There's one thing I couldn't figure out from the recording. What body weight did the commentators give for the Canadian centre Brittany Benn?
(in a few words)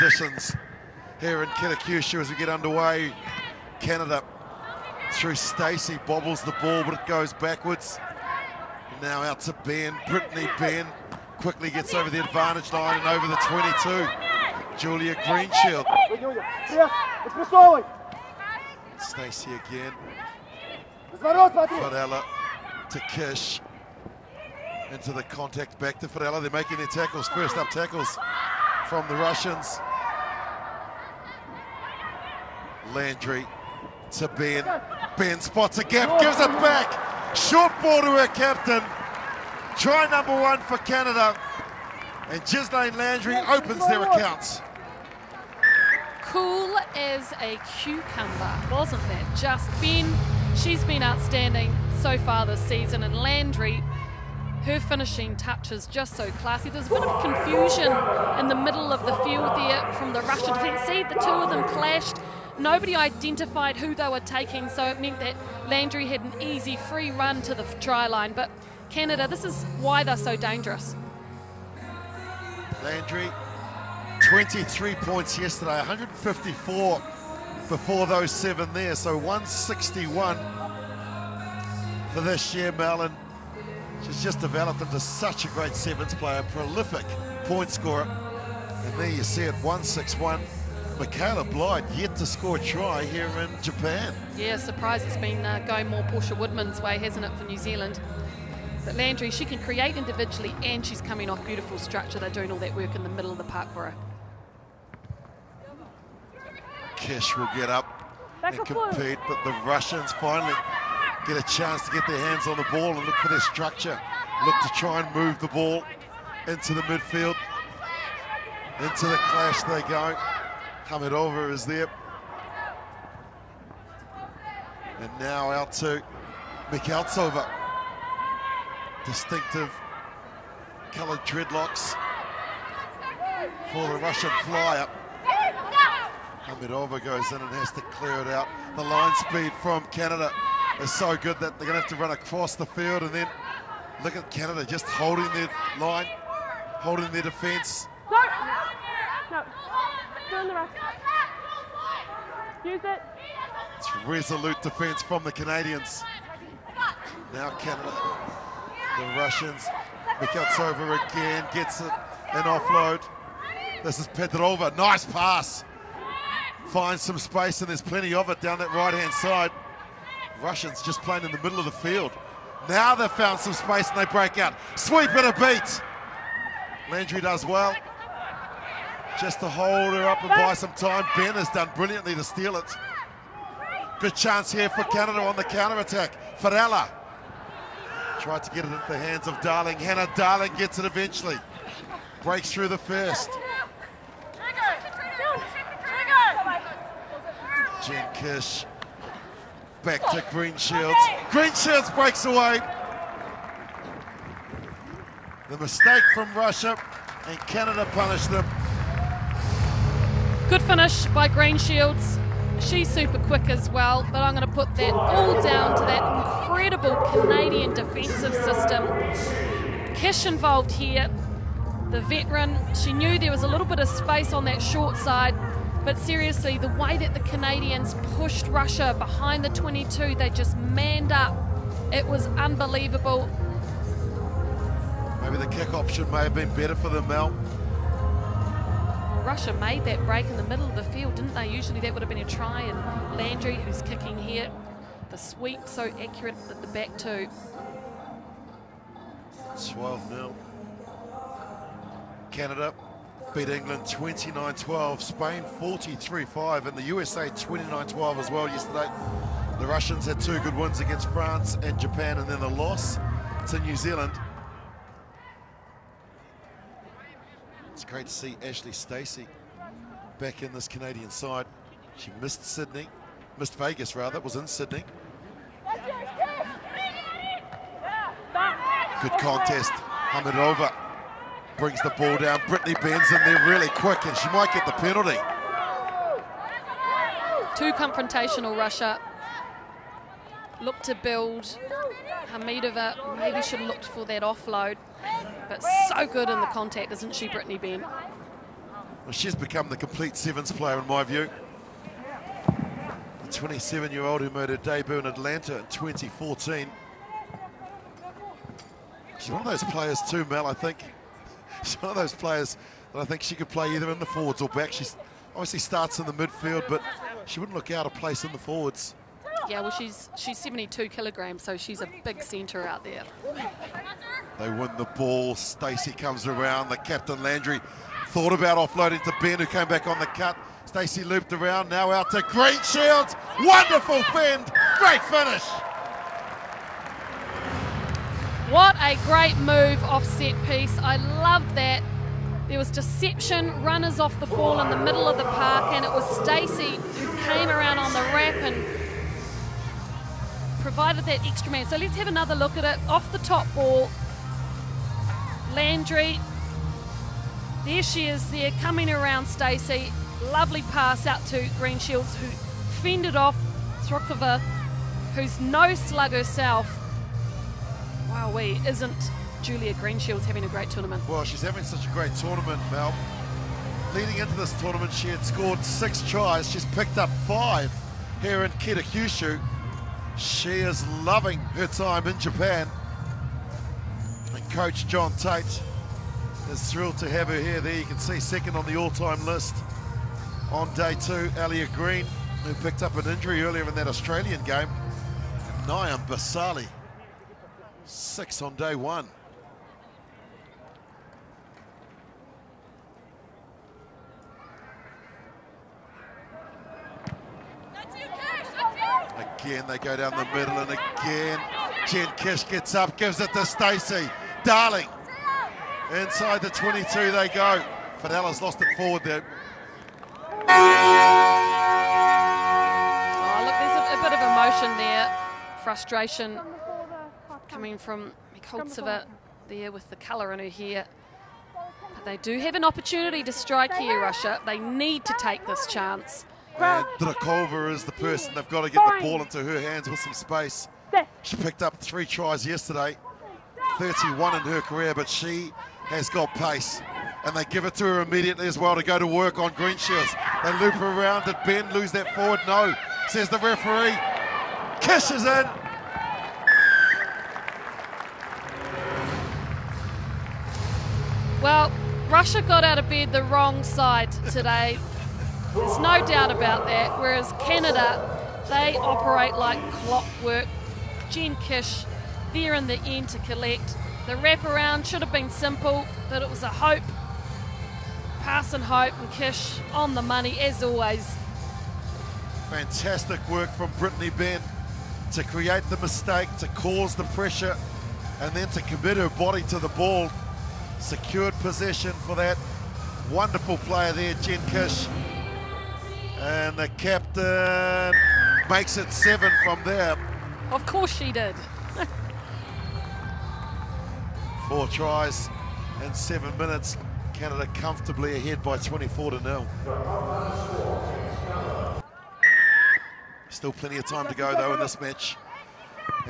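72 kilograms.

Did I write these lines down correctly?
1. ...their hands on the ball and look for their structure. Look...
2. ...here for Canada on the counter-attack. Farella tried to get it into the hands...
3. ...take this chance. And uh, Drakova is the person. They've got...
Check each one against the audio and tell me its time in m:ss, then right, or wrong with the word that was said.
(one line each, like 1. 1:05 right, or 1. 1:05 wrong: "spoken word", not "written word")
1. 1:52 right
2. 3:04 right
3. 7:15 right.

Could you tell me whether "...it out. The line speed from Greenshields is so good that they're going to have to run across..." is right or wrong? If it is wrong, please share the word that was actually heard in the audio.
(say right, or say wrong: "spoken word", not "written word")
wrong: "Canada", not "Greenshields".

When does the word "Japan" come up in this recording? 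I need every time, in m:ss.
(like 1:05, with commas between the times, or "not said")
1:33, 4:21, 6:22.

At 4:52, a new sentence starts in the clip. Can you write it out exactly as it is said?
Hamidova maybe should have looked for that offload.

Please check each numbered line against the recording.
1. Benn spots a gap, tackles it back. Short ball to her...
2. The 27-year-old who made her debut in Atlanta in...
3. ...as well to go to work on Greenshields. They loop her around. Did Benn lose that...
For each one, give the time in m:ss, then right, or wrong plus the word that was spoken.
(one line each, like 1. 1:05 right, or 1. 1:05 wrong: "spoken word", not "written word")
1. 0:35 wrong: "gives", not "tackles"
2. 5:02 right
3. 7:28 right.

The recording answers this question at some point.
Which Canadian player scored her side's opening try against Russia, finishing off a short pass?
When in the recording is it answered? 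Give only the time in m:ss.
0:42.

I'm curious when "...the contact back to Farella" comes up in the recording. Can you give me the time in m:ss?
0:25.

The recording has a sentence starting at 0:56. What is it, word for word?
There's a bit of confusion in the middle of the field there from the Russian defence.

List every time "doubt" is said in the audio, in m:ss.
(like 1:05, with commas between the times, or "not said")
7:46.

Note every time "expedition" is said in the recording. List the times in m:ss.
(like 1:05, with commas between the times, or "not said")
not said.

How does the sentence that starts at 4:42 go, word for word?
Brittany bends in there really quick and she might get the penalty.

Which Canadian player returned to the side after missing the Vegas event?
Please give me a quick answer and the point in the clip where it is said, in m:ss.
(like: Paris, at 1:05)
Ashley Steacy, at 4:28.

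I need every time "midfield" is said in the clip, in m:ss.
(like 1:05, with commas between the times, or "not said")
1:56, 5:16.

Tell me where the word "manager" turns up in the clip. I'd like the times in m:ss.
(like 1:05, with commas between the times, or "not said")
not said.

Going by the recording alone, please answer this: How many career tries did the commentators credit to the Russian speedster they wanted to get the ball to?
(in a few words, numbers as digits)
31.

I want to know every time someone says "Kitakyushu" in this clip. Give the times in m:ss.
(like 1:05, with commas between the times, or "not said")
0:01, 6:18.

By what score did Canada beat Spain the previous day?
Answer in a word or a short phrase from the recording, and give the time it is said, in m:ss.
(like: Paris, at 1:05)
43-5, at 4:15.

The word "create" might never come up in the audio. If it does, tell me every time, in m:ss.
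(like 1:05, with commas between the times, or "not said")
1:39, 8:05.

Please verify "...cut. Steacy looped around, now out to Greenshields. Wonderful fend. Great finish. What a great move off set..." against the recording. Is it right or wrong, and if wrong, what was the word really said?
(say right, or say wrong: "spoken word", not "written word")
right.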